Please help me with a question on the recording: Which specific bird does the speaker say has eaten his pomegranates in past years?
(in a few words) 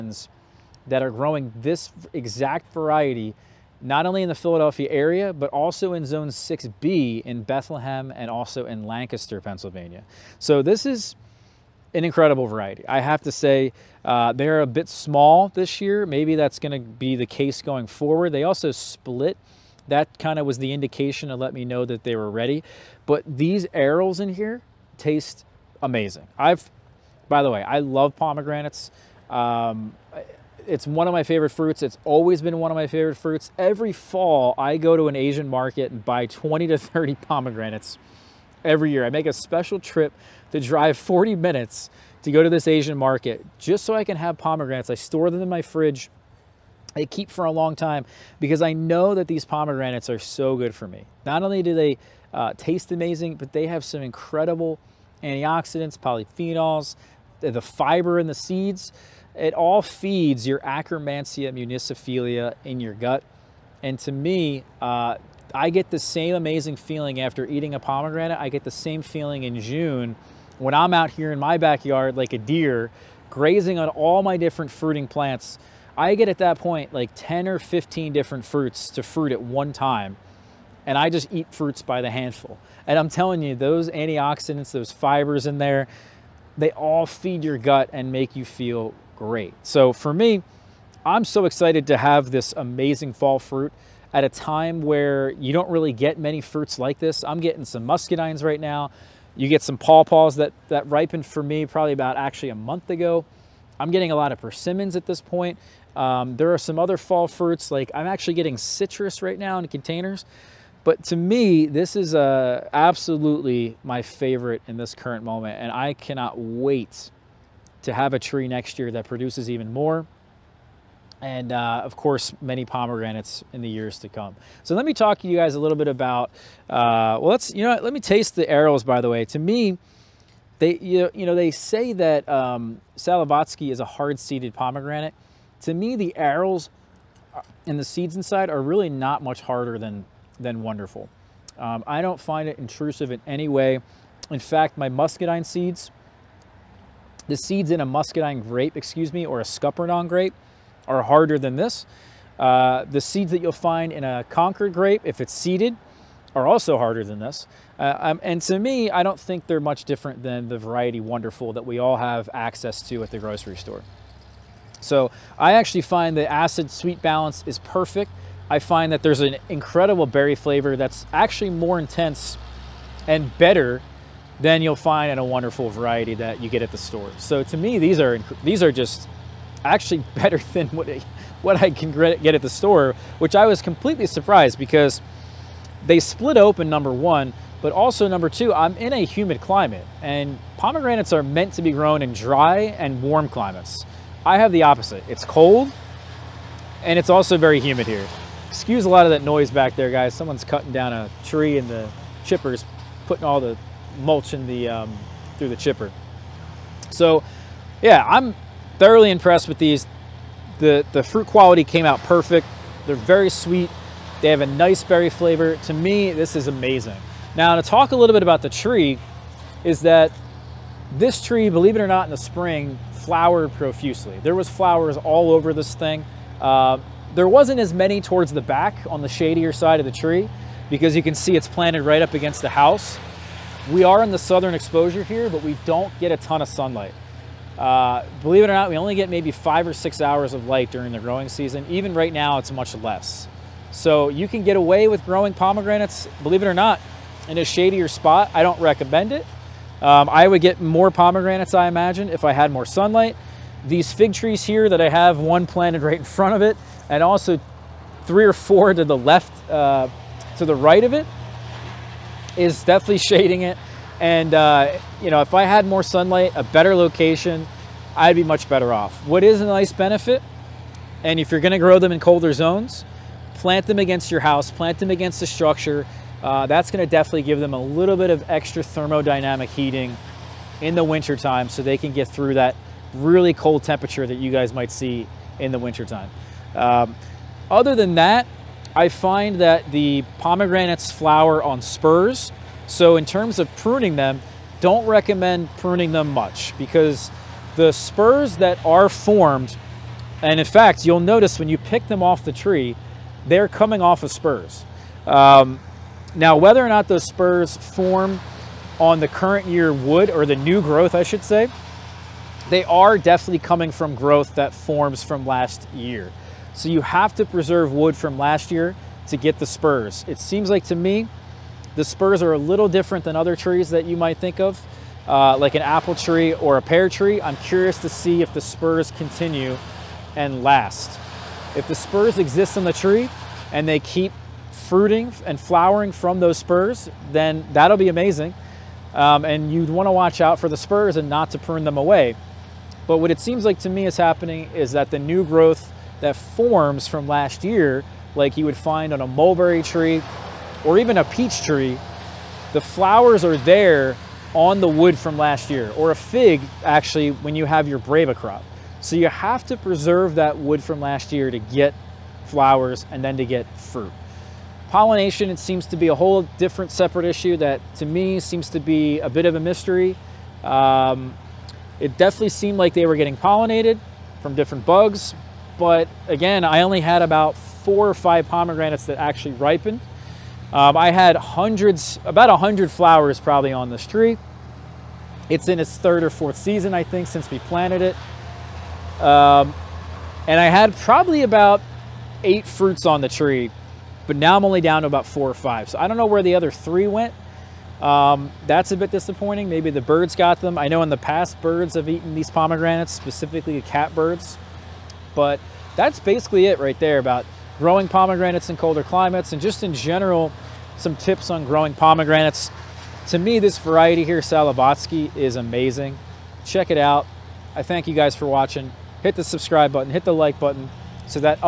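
Catbirds.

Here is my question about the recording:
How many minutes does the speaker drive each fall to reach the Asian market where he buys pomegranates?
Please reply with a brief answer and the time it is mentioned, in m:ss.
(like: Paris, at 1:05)
40, at 0:40.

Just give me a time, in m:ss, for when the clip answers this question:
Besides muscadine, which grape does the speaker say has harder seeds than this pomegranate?
2:29.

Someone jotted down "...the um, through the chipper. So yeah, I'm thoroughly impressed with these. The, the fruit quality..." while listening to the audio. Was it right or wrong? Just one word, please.
right.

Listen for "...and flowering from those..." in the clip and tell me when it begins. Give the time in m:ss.
5:35.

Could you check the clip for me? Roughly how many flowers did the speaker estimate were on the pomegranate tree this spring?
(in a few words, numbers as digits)
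100.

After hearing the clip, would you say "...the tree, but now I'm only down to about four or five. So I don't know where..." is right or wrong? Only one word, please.
right.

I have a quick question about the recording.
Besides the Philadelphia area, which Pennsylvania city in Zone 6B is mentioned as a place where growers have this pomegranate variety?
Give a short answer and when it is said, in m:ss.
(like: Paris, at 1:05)
Bethlehem, at 0:07.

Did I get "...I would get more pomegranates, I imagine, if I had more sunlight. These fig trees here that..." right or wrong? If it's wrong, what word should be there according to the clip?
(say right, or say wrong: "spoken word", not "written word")
right.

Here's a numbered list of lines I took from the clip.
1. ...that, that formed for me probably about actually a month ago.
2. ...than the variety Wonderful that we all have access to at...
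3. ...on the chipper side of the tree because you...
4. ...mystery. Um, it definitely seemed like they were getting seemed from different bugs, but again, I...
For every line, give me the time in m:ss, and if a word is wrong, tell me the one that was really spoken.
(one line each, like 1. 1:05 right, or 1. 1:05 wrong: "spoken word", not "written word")
1. 1:40 wrong: "ripened", not "formed"
2. 2:40 right
3. 3:48 wrong: "shadier", not "chipper"
4. 6:09 wrong: "pollinated", not "seemed".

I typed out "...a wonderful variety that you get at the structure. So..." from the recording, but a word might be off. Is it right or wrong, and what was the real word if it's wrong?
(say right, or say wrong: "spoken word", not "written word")
wrong: "store", not "structure".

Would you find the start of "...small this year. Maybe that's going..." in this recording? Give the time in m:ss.
0:14.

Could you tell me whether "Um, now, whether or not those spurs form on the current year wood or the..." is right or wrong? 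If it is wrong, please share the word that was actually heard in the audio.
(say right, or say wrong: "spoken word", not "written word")
right.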